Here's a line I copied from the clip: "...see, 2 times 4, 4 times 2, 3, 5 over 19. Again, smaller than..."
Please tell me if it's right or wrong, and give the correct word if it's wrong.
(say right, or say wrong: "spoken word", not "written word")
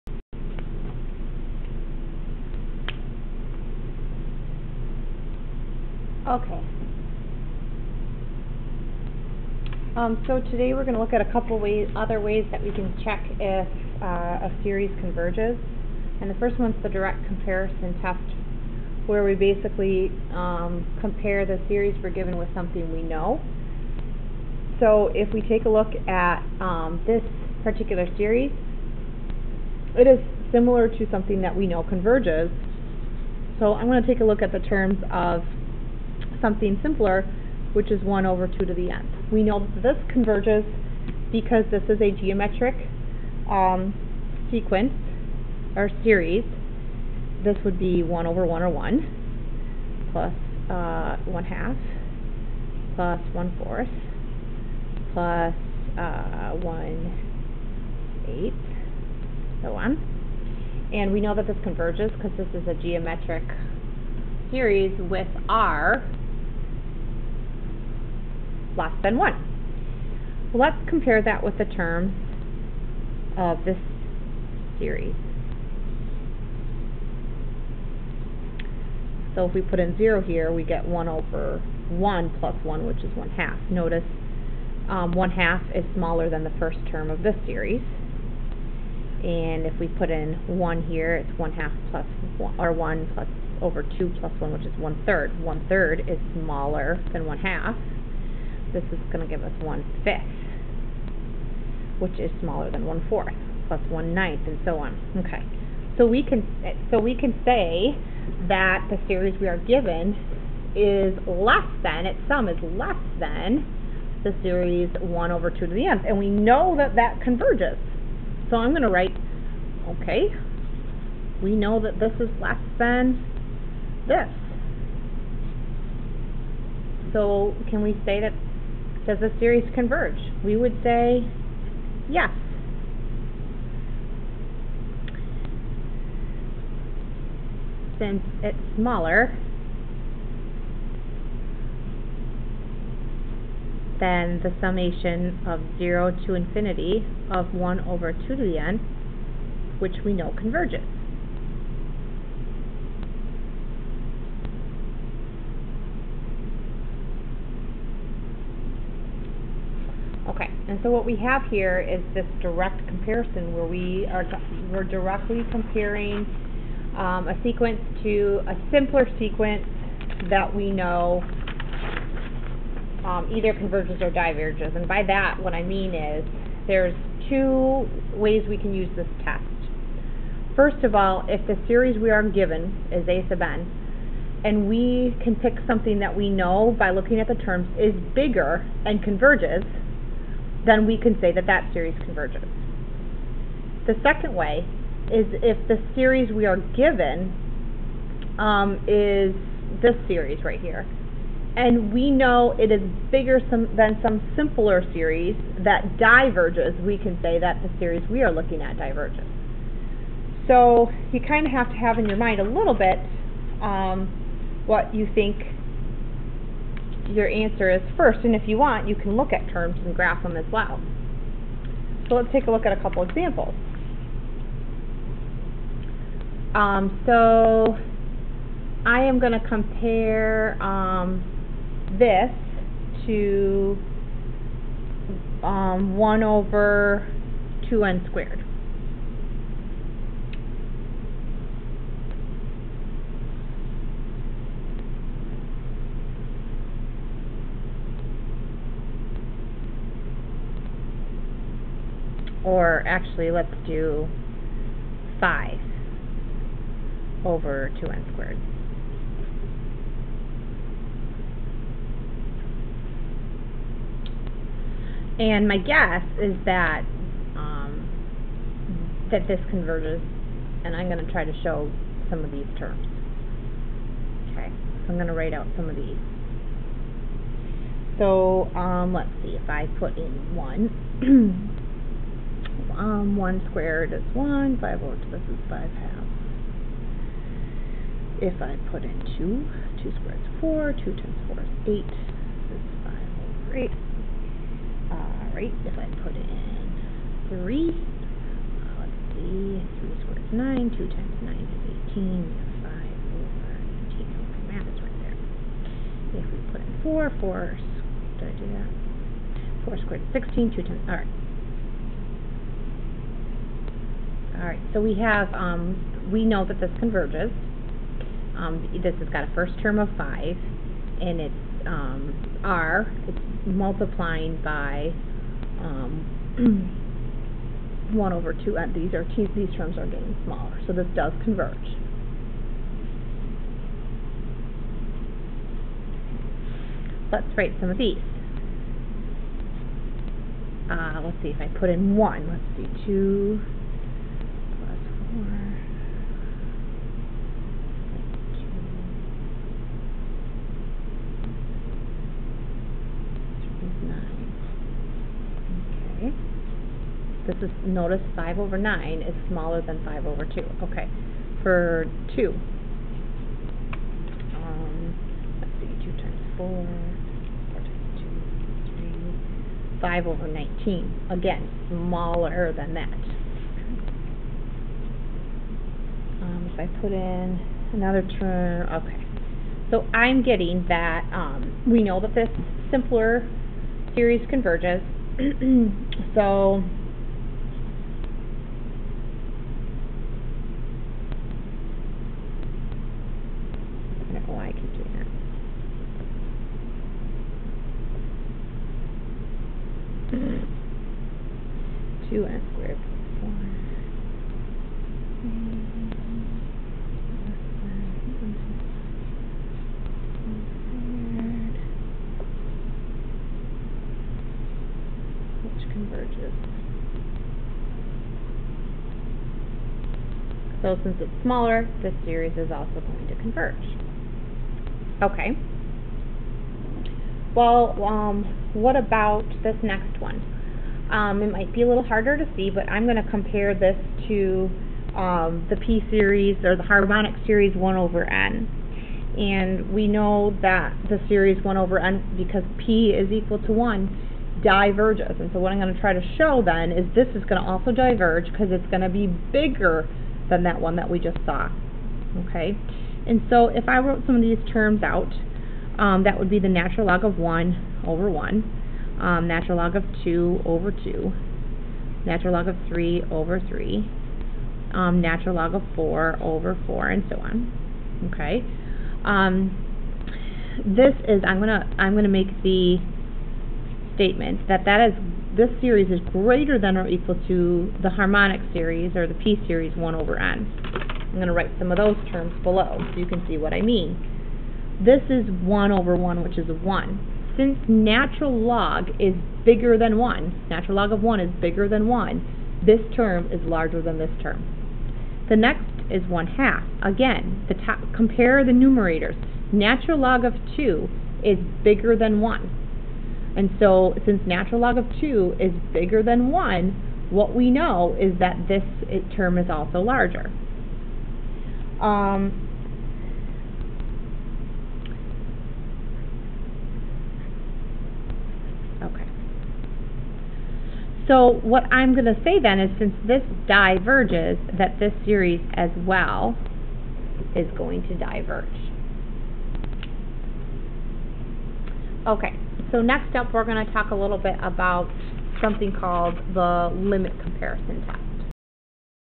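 right.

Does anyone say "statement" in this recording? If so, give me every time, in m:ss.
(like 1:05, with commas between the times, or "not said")
7:53.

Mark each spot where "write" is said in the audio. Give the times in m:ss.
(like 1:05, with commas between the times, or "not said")
1:58, 4:35, 5:37, 8:01.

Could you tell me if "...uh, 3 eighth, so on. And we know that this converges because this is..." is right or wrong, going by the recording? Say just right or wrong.
wrong.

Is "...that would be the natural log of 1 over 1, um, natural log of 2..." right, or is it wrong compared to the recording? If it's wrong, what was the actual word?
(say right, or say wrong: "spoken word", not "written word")
right.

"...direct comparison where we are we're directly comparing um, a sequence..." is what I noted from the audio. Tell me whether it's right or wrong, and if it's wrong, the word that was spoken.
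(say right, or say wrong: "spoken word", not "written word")
right.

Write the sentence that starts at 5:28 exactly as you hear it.
and uh, these, are, these terms are getting smaller, so this does converge.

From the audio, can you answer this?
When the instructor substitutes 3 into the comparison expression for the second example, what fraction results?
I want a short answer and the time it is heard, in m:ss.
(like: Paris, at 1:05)
5/18, at 5:02.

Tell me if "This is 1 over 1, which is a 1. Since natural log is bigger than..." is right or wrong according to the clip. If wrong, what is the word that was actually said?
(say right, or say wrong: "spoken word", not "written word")
right.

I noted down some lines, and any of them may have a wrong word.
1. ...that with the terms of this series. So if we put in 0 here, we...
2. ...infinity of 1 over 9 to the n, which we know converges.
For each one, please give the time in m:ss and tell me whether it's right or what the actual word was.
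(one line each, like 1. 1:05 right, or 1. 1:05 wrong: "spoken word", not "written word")
1. 1:11 right
2. 2:26 wrong: "2", not "9".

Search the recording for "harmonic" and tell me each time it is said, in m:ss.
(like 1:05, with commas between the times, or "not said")
7:16, 7:57.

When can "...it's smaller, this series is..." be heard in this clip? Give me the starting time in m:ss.
7:01.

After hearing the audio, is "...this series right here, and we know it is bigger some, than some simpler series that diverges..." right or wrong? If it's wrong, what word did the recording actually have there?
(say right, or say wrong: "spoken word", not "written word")
right.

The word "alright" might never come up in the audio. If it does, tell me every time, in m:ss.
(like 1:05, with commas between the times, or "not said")
4:54, 5:10.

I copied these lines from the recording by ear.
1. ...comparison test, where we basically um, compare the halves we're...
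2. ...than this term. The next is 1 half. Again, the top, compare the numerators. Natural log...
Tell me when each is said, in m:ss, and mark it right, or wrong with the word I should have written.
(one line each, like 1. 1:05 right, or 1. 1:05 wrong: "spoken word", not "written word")
1. 0:17 wrong: "series", not "halves"
2. 8:13 right.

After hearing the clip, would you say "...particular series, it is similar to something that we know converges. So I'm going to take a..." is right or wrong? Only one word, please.
right.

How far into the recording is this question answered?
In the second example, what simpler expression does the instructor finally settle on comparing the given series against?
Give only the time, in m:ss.
4:15.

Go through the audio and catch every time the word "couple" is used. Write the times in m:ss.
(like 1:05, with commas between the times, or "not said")
0:11, 3:42.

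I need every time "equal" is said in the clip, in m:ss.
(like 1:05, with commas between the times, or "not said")
7:23, 7:56.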